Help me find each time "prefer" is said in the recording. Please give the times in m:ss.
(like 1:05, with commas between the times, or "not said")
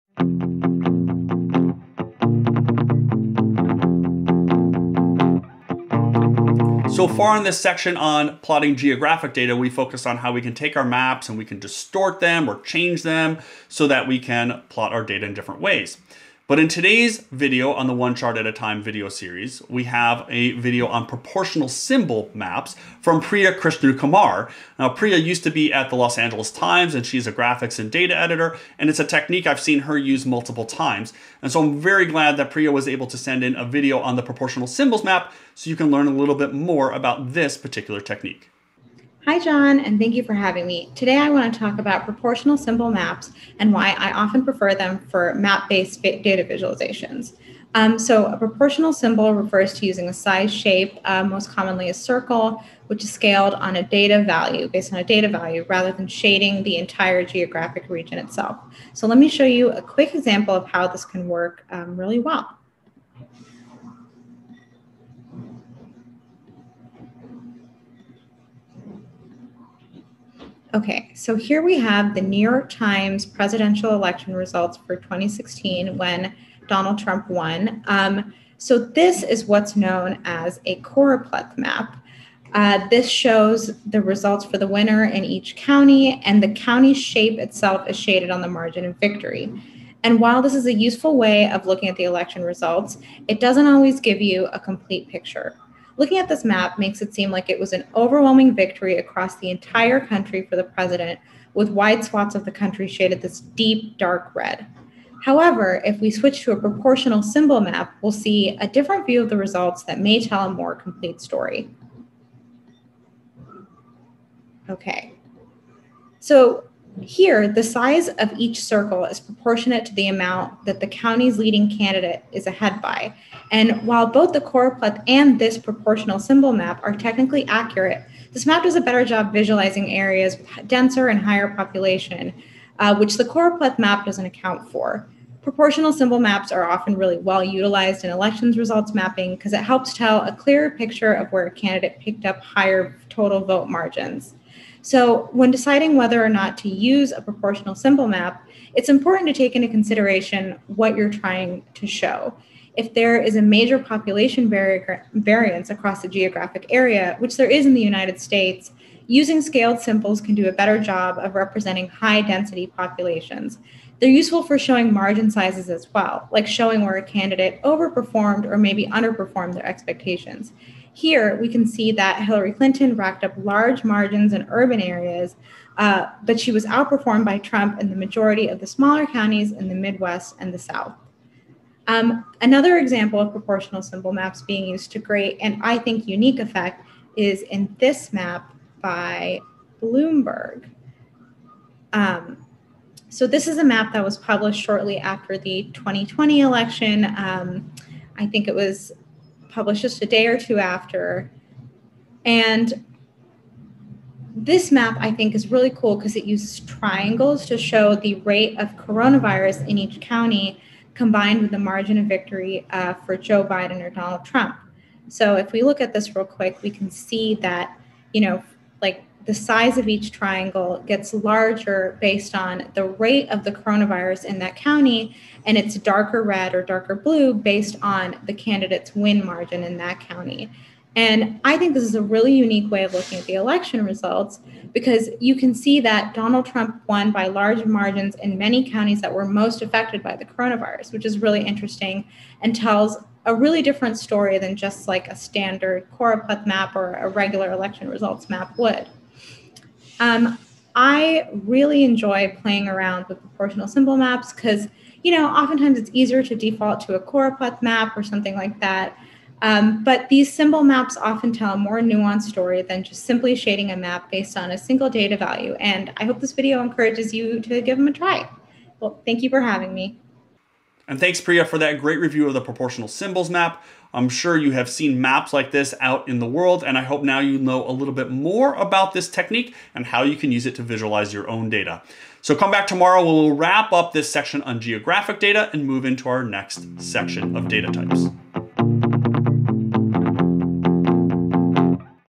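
0:44.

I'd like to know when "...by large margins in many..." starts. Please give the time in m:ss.
3:57.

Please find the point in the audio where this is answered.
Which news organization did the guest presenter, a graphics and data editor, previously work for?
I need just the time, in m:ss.
0:25.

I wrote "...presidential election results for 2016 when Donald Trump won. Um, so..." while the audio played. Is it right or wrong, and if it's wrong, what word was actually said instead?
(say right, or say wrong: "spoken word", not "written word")
right.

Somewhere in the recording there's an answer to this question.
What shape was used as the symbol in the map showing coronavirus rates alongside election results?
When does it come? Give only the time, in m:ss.
3:26.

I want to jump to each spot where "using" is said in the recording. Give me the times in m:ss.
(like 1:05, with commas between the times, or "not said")
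0:49, 2:39.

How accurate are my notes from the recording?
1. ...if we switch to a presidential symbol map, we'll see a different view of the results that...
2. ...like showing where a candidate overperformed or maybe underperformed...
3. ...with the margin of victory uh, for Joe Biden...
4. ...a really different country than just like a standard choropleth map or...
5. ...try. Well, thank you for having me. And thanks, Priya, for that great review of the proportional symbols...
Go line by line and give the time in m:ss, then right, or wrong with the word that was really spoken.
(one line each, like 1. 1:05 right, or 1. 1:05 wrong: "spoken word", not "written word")
1. 1:45 wrong: "proportional", not "presidential"
2. 2:46 right
3. 3:31 right
4. 4:03 wrong: "story", not "country"
5. 4:27 right.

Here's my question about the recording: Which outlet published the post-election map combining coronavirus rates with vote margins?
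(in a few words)
Bloomberg.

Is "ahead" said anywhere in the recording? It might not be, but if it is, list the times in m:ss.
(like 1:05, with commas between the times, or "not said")
2:02.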